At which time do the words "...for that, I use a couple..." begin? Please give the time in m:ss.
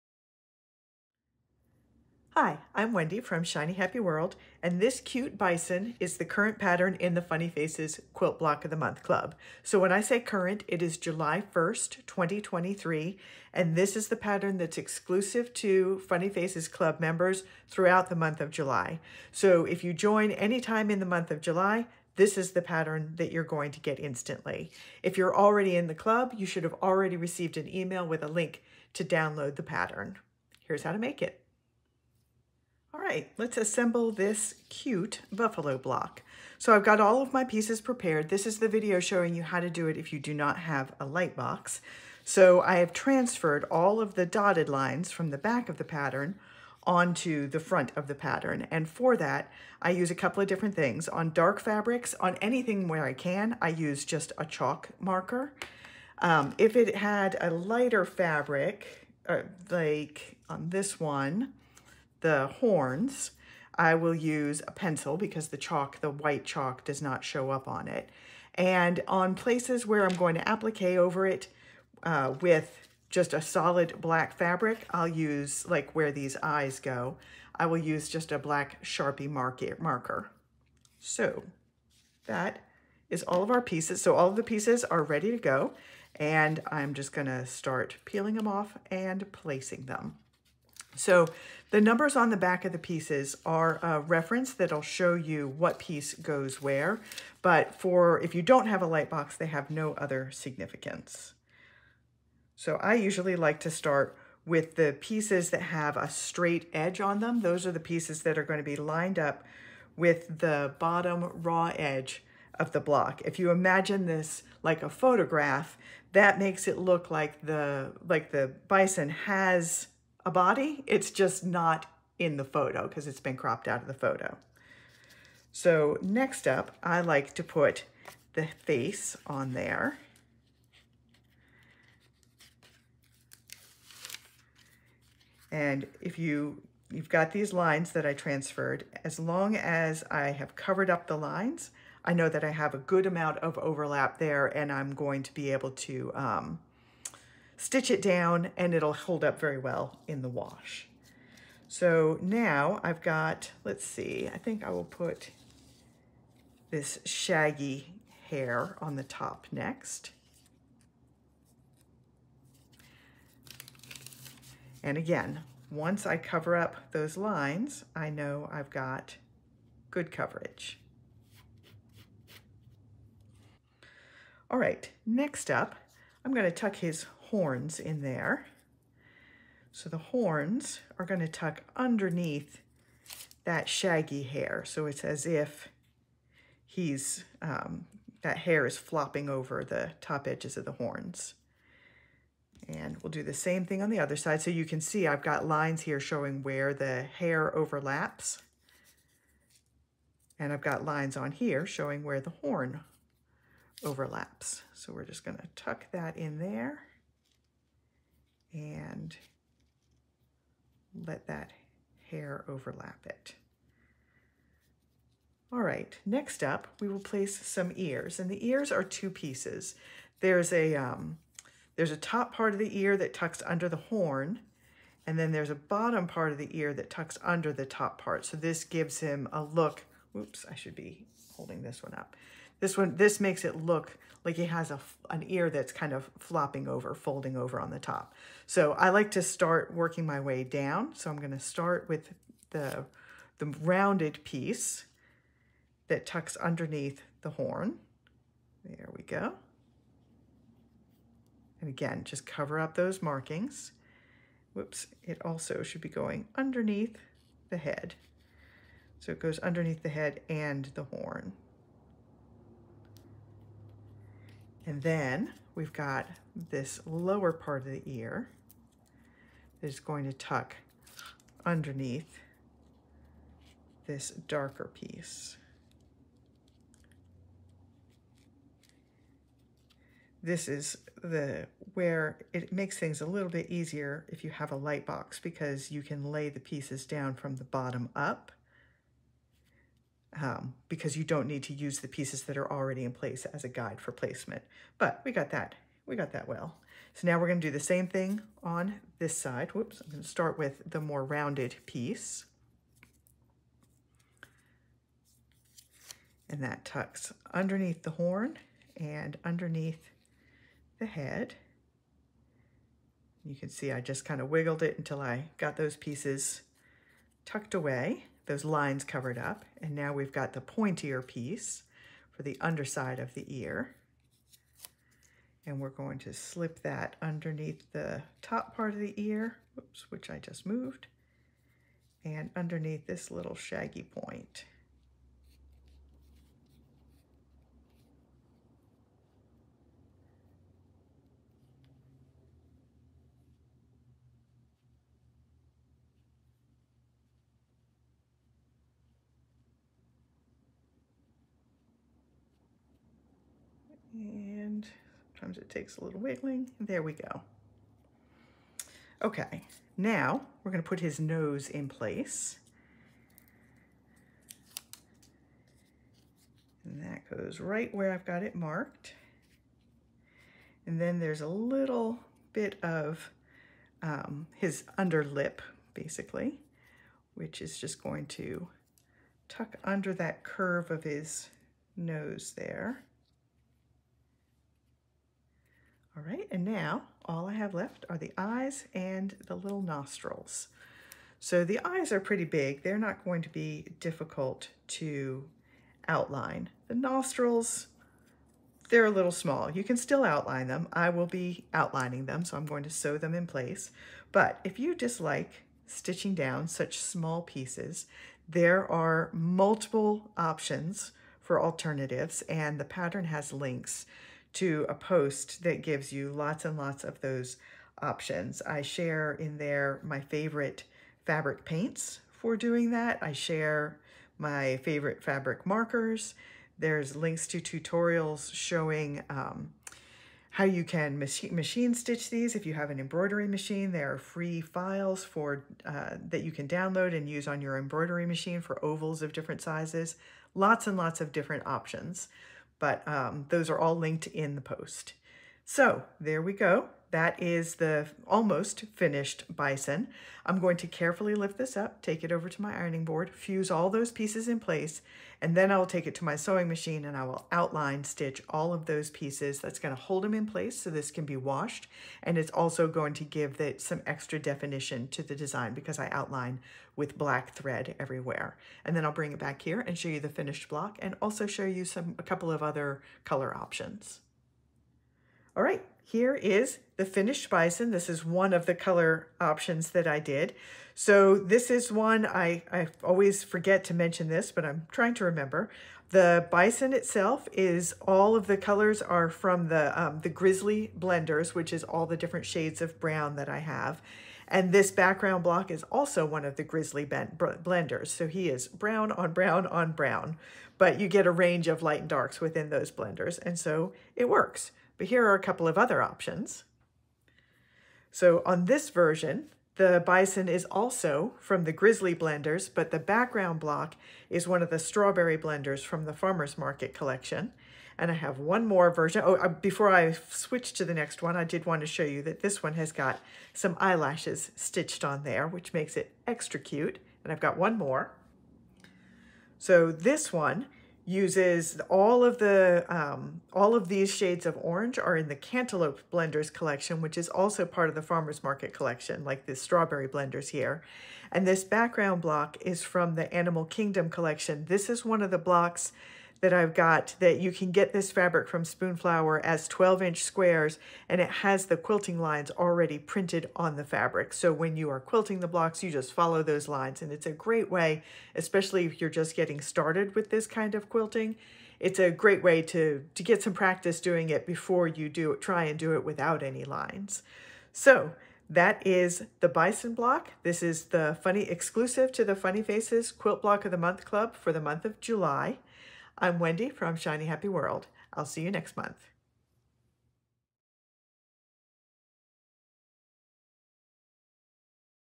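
0:48.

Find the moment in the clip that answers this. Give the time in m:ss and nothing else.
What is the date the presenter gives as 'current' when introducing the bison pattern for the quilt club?
0:10.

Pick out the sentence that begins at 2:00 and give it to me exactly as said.
It's just not in the photo because it's been cropped out of the photo.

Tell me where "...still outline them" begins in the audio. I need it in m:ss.
6:39.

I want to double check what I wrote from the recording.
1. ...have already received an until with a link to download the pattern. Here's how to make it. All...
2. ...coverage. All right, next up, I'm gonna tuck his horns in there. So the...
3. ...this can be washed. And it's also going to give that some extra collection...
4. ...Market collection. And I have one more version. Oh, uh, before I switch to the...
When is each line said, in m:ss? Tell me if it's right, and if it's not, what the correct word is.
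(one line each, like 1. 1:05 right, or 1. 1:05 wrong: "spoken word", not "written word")
1. 0:26 wrong: "email", not "until"
2. 2:50 right
3. 7:40 wrong: "definition", not "collection"
4. 8:36 right.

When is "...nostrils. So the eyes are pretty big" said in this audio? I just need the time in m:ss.
6:29.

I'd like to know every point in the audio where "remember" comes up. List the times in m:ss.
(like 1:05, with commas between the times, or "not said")
8:05.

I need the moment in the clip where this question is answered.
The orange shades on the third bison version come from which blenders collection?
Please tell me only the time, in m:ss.
8:55.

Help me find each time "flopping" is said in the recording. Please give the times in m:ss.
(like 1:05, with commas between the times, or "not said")
3:08, 3:56.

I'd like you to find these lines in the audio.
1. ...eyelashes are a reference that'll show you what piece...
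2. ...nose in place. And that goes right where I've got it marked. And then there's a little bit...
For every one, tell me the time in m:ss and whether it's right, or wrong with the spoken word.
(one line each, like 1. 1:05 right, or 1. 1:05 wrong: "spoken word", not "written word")
1. 1:32 wrong: "pieces", not "eyelashes"
2. 6:00 right.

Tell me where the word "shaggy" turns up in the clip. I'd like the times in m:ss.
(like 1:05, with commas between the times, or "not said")
2:37, 3:03, 5:33.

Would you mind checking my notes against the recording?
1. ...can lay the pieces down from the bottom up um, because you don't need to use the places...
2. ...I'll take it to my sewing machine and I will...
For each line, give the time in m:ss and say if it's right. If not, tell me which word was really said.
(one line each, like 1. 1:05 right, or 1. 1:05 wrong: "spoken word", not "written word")
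1. 4:45 wrong: "pieces", not "places"
2. 7:35 right.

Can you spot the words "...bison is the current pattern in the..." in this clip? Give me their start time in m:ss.
0:05.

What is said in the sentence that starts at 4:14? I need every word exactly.
Whoops, it also should be going underneath the head.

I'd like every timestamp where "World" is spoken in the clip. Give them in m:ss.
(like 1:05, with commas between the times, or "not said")
0:03, 9:37.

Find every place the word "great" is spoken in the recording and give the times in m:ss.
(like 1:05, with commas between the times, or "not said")
9:17, 9:21.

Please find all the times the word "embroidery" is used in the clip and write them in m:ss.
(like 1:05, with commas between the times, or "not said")
7:12, 7:17.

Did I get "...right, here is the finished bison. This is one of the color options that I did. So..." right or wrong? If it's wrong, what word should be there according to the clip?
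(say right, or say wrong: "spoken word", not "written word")
right.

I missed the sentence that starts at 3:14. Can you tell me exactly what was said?
So you can see I've got lines here showing where the hair overlaps.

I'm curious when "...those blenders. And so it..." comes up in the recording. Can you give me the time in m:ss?
8:22.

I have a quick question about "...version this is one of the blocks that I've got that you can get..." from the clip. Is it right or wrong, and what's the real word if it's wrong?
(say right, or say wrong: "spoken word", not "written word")
wrong: "collection", not "version".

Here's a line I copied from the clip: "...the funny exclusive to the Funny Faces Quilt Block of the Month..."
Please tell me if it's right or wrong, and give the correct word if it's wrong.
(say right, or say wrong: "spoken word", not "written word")
right.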